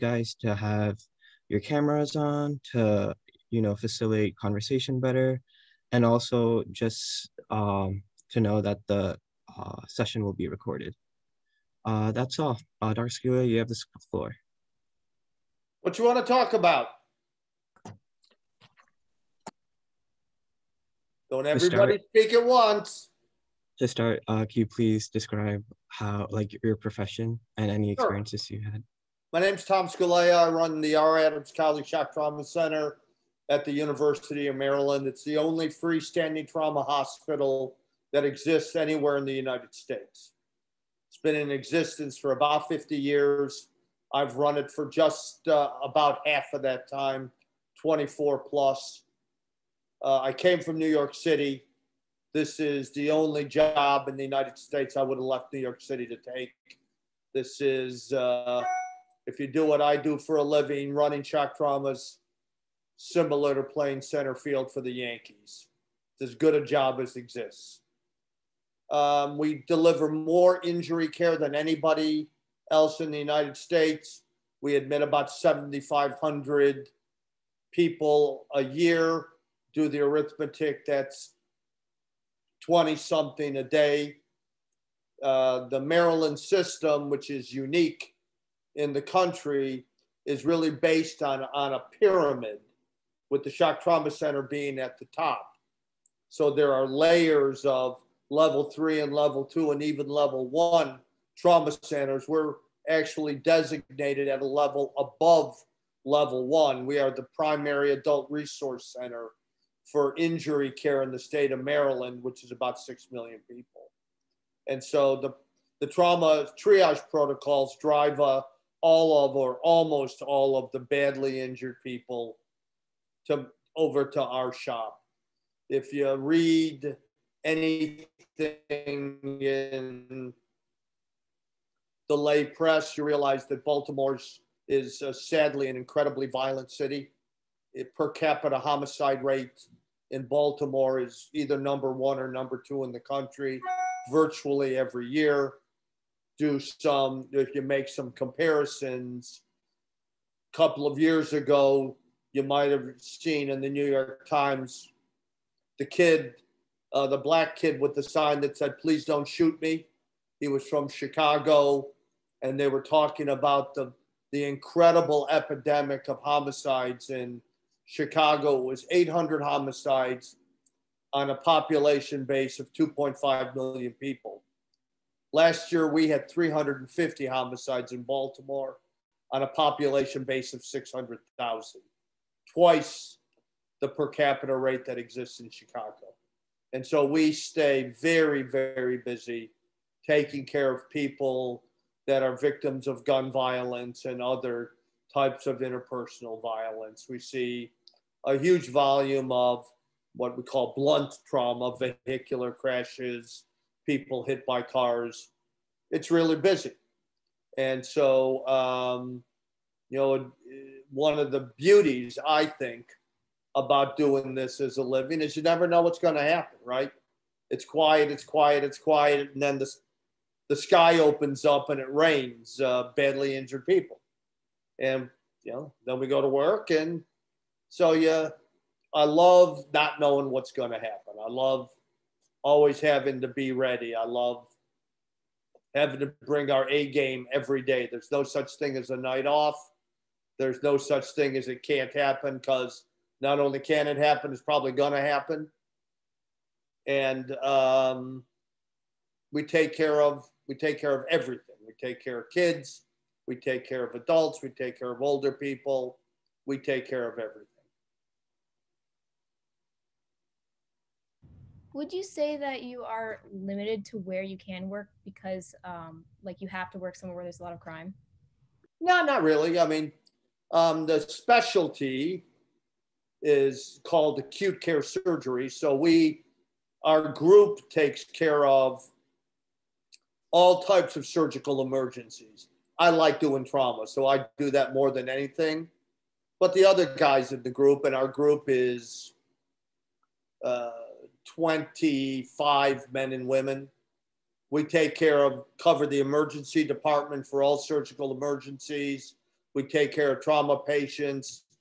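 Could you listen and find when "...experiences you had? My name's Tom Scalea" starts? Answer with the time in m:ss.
0:27.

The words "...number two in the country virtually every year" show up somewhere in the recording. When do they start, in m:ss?
2:22.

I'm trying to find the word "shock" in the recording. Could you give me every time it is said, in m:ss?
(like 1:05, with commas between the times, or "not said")
0:31, 1:01, 1:33.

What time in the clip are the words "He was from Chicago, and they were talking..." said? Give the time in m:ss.
2:40.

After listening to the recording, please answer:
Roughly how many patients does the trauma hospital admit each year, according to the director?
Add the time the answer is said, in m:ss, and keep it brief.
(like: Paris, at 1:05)
7,500, at 1:15.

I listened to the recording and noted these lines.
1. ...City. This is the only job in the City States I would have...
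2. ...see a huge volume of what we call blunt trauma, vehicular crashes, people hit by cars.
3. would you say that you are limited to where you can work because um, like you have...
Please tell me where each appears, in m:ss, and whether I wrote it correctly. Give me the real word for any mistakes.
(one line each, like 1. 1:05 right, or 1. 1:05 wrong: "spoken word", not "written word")
1. 0:51 wrong: "United", not "City"
2. 3:17 right
3. 4:21 right.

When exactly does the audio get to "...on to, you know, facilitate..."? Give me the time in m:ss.
0:02.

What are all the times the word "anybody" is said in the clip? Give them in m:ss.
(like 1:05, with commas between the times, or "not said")
1:11.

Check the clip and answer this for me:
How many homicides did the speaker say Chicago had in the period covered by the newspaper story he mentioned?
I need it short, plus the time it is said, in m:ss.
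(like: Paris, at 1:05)
800, at 2:48.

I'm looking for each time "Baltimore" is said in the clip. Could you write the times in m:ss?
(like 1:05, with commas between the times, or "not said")
2:13, 2:20, 2:58.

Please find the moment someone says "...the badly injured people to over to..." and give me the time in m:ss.
2:00.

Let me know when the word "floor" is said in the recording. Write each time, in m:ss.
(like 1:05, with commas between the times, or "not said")
0:14.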